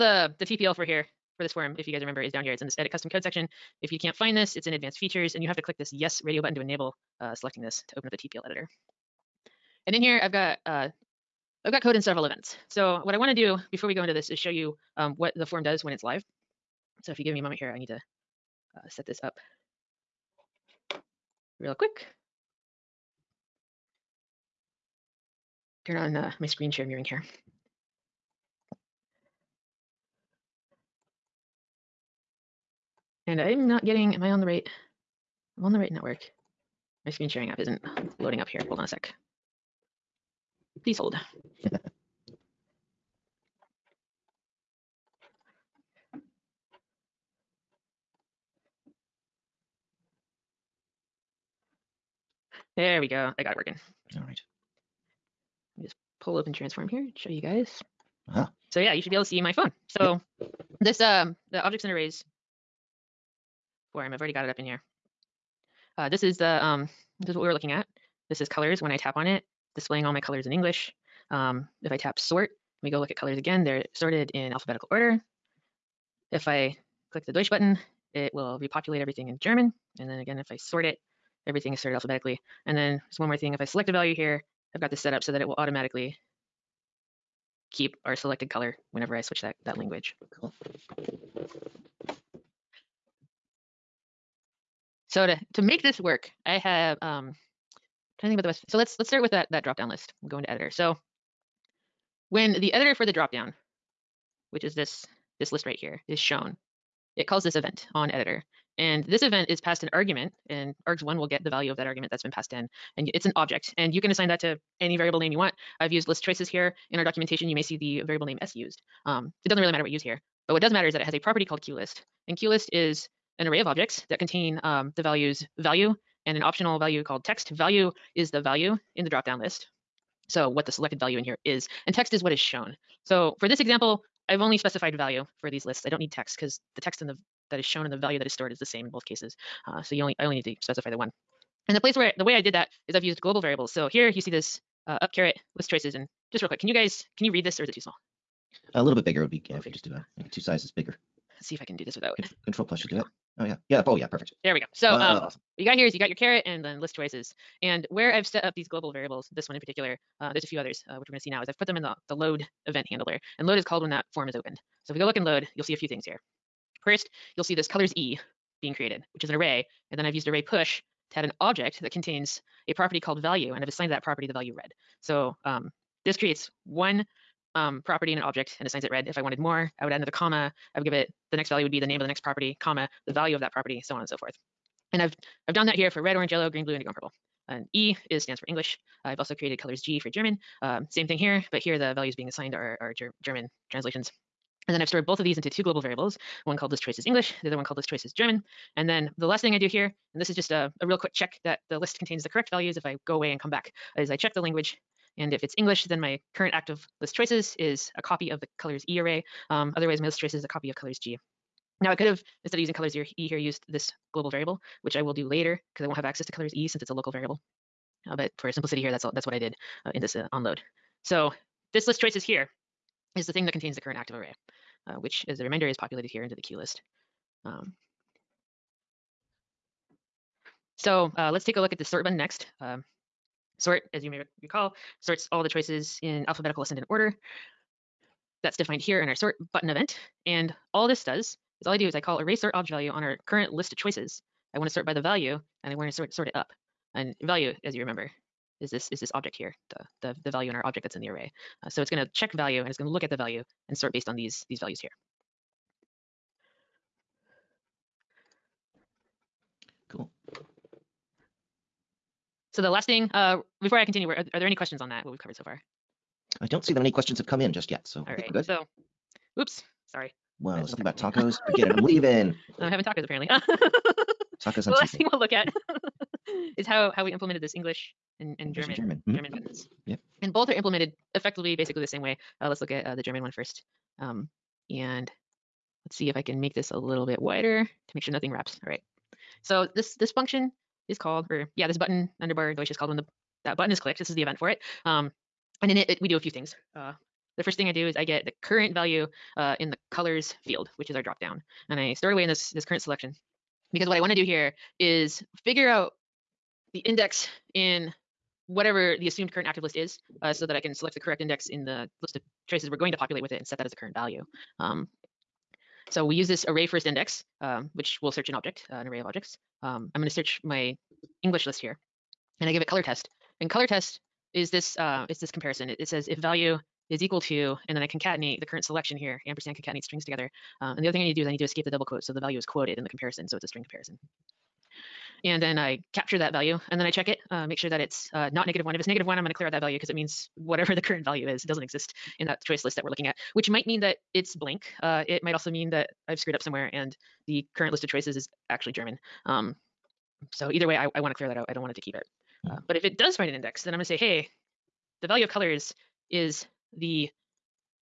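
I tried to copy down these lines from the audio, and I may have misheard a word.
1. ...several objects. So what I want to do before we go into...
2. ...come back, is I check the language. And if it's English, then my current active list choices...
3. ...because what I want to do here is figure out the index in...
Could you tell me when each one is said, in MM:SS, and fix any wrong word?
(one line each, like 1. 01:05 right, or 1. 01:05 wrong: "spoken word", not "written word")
1. 00:12 wrong: "events", not "objects"
2. 03:23 right
3. 05:03 right.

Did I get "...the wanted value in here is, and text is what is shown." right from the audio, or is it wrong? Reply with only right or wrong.
wrong.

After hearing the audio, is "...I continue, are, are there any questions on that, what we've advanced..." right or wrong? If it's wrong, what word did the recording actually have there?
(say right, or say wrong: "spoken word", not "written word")
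wrong: "covered", not "advanced".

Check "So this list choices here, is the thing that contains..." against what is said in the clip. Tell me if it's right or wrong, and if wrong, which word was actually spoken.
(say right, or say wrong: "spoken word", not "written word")
right.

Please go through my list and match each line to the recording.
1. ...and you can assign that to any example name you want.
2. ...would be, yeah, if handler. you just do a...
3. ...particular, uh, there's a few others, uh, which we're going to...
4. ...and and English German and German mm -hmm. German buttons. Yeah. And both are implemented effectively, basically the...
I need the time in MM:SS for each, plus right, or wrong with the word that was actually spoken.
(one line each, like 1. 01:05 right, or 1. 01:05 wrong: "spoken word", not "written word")
1. 01:53 wrong: "variable", not "example"
2. 02:29 wrong: "bigger", not "handler"
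3. 02:39 right
4. 04:38 right.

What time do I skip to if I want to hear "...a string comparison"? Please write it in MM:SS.
05:33.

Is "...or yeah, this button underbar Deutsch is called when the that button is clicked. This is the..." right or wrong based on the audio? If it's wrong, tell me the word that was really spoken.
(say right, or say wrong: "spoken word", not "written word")
right.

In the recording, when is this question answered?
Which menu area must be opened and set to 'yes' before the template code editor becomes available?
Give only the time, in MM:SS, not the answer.
00:04.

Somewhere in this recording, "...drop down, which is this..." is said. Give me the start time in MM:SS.
01:43.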